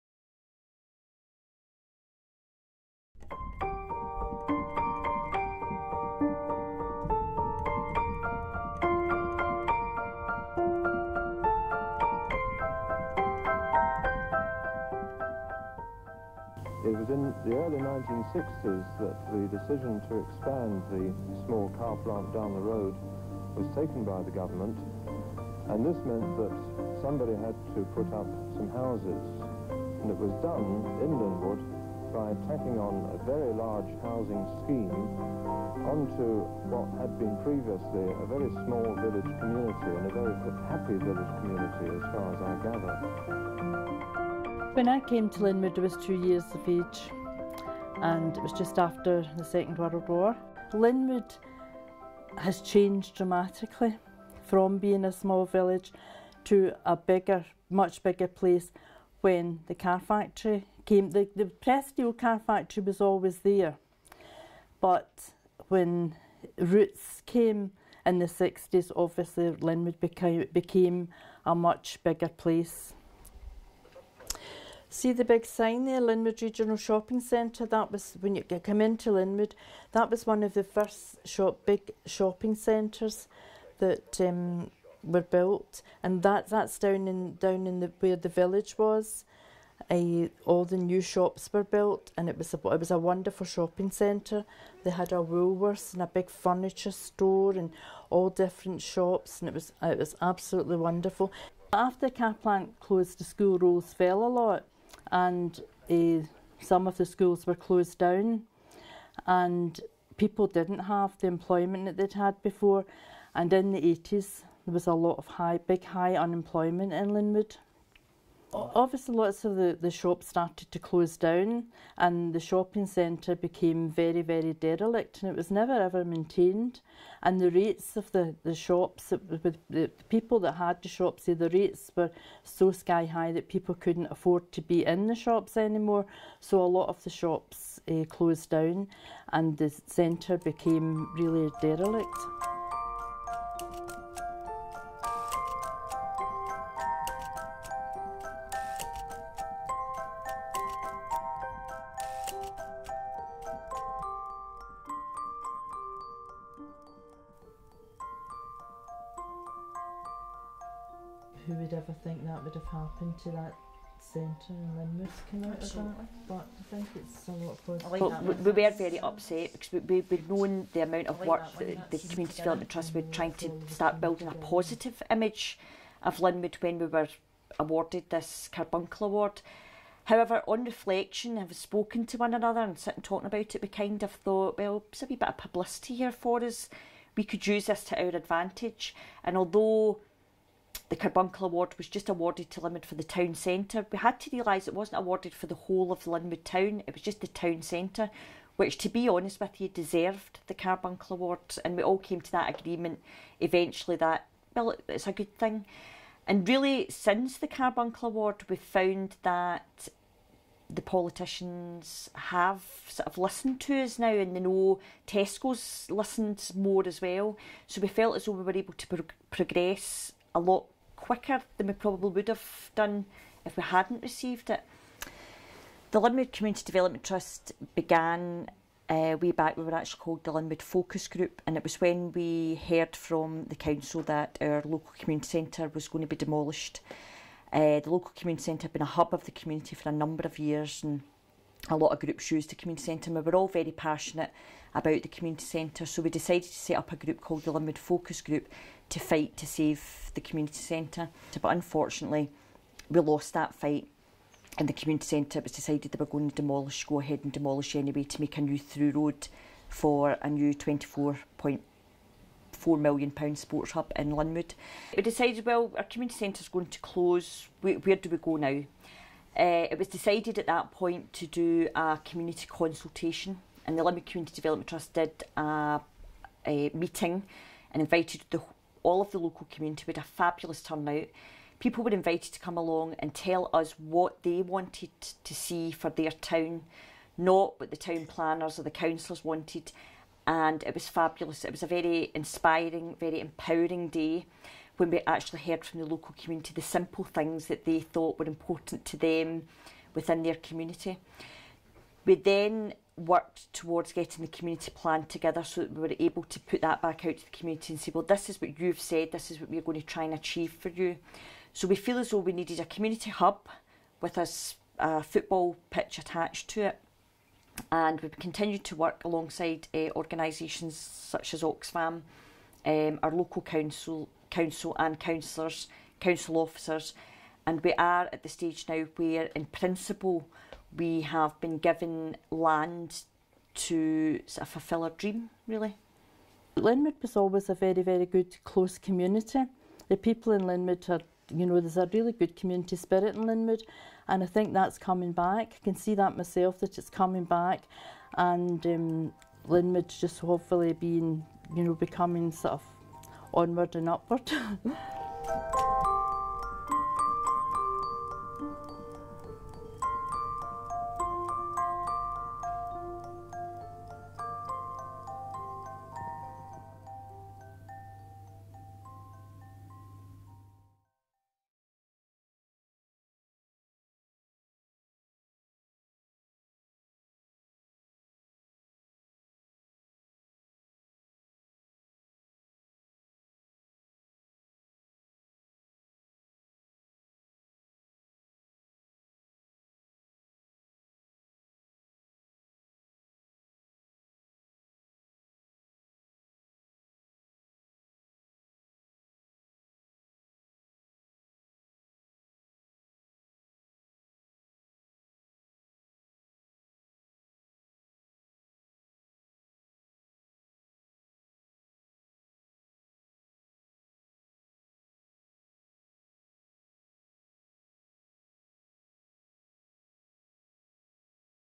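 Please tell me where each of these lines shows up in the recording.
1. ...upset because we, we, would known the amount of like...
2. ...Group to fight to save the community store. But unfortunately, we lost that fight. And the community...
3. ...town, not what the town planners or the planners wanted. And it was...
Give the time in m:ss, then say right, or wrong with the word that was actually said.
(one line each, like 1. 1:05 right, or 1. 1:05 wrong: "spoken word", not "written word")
1. 2:48 right
2. 4:08 wrong: "centre", not "store"
3. 4:46 wrong: "councillors", not "planners".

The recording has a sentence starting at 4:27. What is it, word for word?
Where, where do we go now?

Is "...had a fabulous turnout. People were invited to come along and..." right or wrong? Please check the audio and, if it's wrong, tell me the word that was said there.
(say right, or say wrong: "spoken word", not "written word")
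right.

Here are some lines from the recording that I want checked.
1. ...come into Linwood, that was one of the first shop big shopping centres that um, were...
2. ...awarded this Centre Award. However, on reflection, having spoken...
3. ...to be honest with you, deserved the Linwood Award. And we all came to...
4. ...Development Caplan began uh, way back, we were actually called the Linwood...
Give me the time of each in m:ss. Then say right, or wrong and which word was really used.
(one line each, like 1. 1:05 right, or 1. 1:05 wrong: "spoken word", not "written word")
1. 1:18 right
2. 2:57 wrong: "Carbuncle", not "Centre"
3. 3:18 wrong: "Carbuncle", not "Linwood"
4. 3:46 wrong: "Trust", not "Caplan".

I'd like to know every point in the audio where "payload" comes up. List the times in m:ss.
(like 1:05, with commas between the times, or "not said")
not said.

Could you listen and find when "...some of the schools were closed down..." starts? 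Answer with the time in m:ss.
1:46.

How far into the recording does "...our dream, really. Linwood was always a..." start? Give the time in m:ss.
5:34.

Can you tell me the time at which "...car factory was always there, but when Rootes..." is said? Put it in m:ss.
1:02.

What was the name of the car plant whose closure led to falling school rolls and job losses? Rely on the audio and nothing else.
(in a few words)
Caplan.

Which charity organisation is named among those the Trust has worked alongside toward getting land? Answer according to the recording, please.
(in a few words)
Oxfam.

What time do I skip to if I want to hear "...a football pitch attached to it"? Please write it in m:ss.
5:14.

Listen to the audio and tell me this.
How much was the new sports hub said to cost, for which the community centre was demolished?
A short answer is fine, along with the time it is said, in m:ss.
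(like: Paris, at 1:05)
£24.4 million, at 4:20.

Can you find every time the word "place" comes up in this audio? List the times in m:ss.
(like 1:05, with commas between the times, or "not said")
0:58, 1:12.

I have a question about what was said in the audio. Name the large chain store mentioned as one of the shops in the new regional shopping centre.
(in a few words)
Woolworths.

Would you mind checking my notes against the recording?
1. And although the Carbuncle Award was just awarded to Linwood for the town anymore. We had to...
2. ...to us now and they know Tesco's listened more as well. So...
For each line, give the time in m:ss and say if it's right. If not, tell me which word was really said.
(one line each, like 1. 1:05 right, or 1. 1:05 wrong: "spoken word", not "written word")
1. 3:09 wrong: "centre", not "anymore"
2. 3:33 right.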